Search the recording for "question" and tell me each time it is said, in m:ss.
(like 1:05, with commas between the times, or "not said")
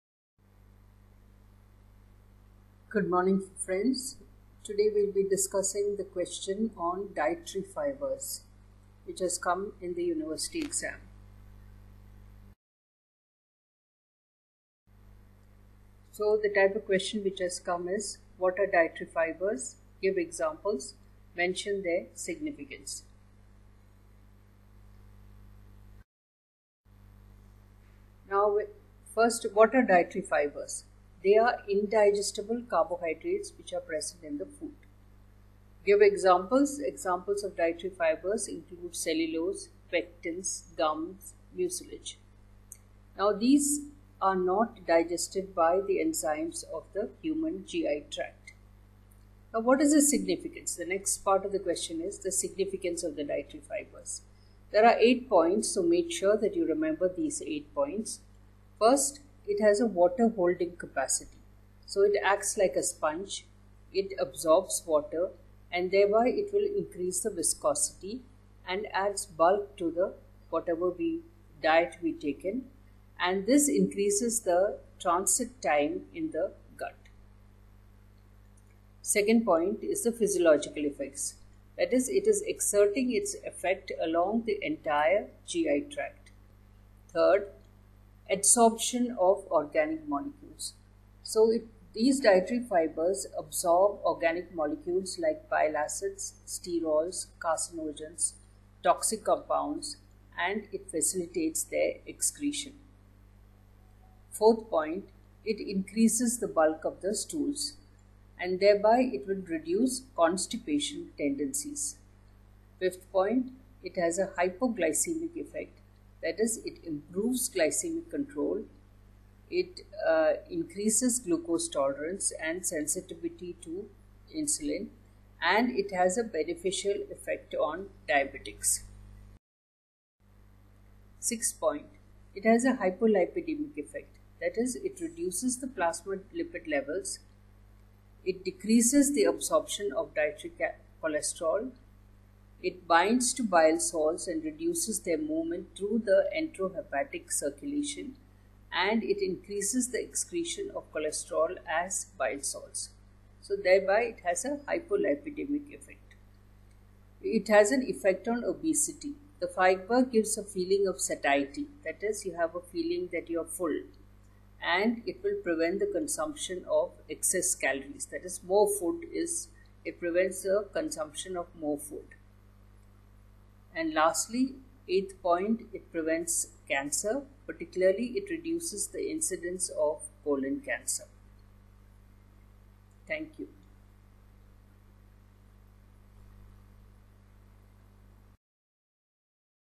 0:06, 0:16, 0:51.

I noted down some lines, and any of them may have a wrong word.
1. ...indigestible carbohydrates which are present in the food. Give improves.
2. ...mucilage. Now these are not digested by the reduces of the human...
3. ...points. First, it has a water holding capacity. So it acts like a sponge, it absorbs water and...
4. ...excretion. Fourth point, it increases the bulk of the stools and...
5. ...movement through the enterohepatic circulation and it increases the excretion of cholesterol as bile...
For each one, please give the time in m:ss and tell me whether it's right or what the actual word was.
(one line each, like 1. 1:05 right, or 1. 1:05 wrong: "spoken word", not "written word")
1. 0:31 wrong: "examples", not "improves"
2. 0:41 wrong: "enzymes", not "reduces"
3. 0:57 right
4. 1:42 right
5. 2:25 right.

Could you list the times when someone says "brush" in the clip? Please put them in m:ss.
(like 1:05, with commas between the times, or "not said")
not said.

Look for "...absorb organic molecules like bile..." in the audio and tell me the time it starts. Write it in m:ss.
1:33.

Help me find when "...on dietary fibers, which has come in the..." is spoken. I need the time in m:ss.
0:06.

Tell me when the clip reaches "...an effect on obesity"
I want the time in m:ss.
2:37.